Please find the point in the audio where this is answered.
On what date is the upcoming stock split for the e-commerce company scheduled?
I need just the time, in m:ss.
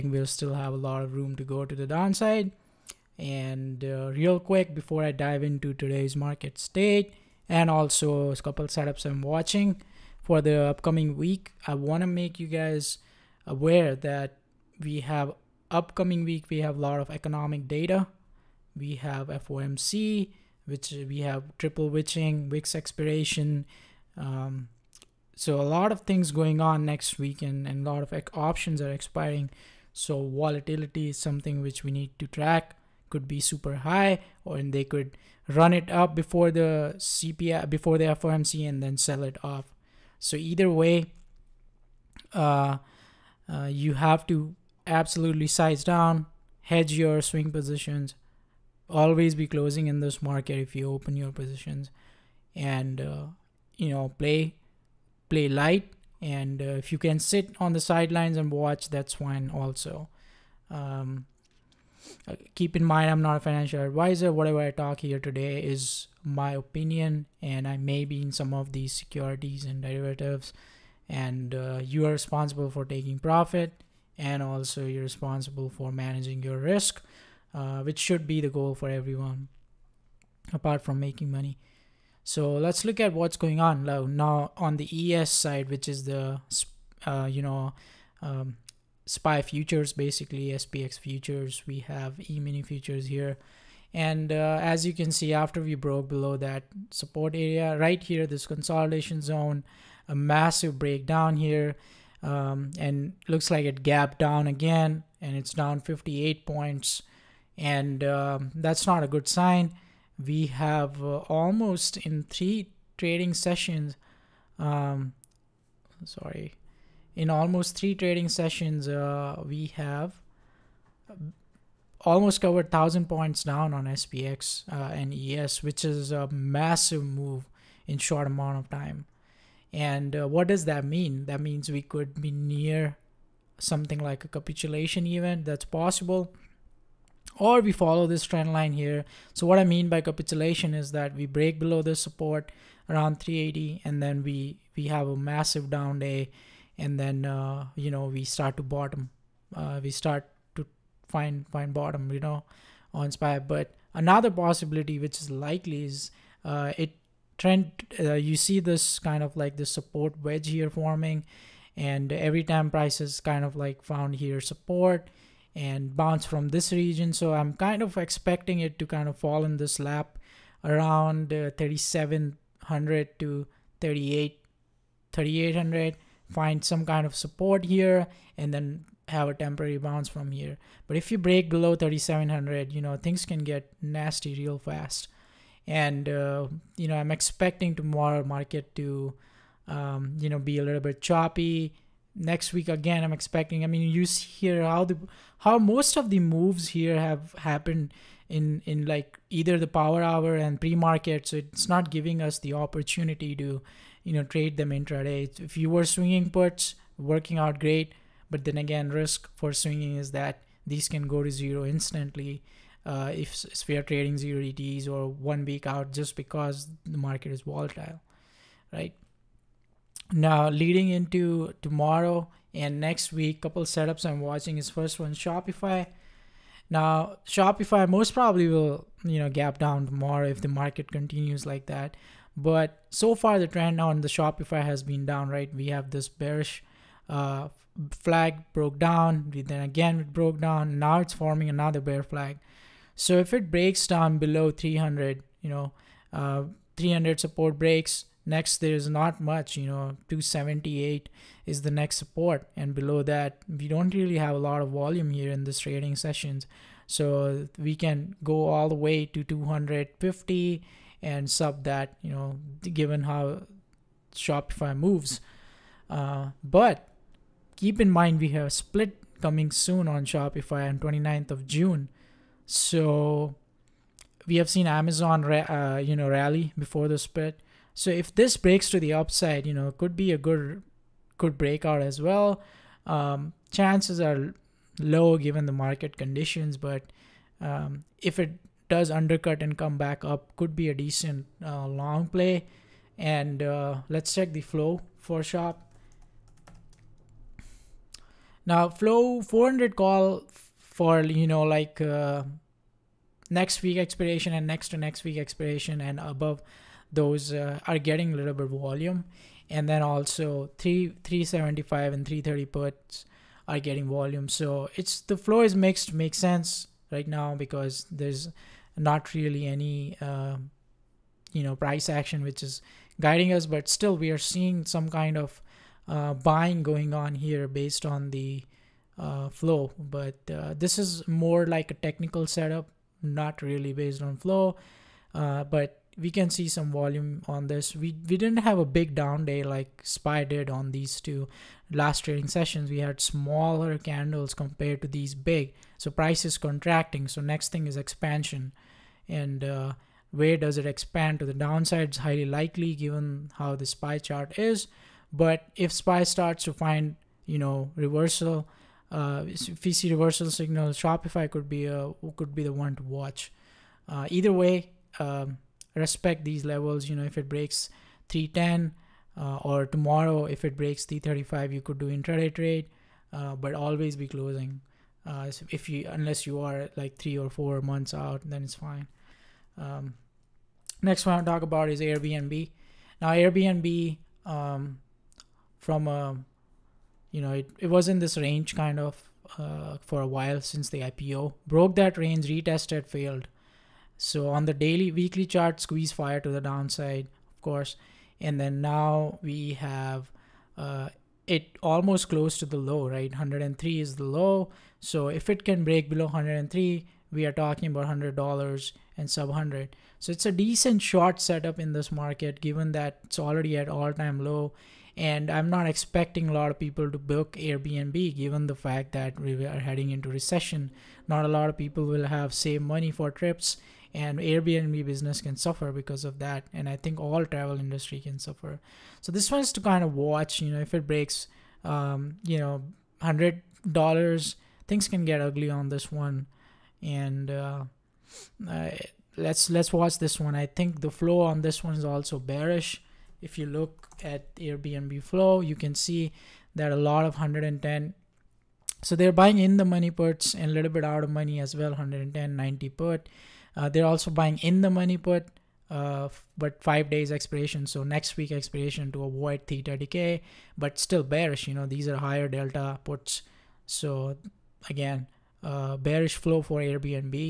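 4:30.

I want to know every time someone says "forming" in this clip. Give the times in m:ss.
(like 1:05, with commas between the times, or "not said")
2:40, 4:01.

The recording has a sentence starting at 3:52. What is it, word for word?
But so far the trend on the Shopify has been down, right?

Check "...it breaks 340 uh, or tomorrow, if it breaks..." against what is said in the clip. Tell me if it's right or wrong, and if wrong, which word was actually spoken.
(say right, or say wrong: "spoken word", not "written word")
wrong: "310", not "340".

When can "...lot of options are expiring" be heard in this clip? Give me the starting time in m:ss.
0:27.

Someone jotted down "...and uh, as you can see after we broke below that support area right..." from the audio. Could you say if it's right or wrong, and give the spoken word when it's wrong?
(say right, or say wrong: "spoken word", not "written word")
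right.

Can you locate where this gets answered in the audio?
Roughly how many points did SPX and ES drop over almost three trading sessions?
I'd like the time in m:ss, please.
2:02.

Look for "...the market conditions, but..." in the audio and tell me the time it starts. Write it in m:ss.
4:45.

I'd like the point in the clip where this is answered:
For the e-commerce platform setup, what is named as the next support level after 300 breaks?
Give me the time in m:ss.
4:10.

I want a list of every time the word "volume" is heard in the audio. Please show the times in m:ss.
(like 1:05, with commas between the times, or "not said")
4:14, 5:08, 5:13, 5:36.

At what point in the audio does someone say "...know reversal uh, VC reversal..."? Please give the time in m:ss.
5:57.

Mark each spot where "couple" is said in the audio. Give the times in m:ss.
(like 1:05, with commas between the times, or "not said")
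0:08, 3:43.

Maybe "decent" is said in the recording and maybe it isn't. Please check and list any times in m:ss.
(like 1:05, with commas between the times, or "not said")
4:50, 6:50.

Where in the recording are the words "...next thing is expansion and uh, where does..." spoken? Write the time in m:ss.
5:47.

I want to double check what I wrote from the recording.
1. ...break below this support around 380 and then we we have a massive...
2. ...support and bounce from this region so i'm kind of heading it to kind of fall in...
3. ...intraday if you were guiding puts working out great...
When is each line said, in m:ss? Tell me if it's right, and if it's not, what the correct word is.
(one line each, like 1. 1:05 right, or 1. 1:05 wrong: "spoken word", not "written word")
1. 2:21 right
2. 2:44 wrong: "expecting", not "heading"
3. 3:24 wrong: "swinging", not "guiding".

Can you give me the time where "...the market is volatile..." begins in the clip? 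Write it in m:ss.
3:36.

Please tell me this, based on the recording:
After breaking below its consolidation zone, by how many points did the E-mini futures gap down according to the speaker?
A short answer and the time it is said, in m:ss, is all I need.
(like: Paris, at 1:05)
58, at 1:45.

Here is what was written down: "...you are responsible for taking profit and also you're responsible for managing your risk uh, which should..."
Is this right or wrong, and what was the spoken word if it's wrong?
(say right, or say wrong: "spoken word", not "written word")
right.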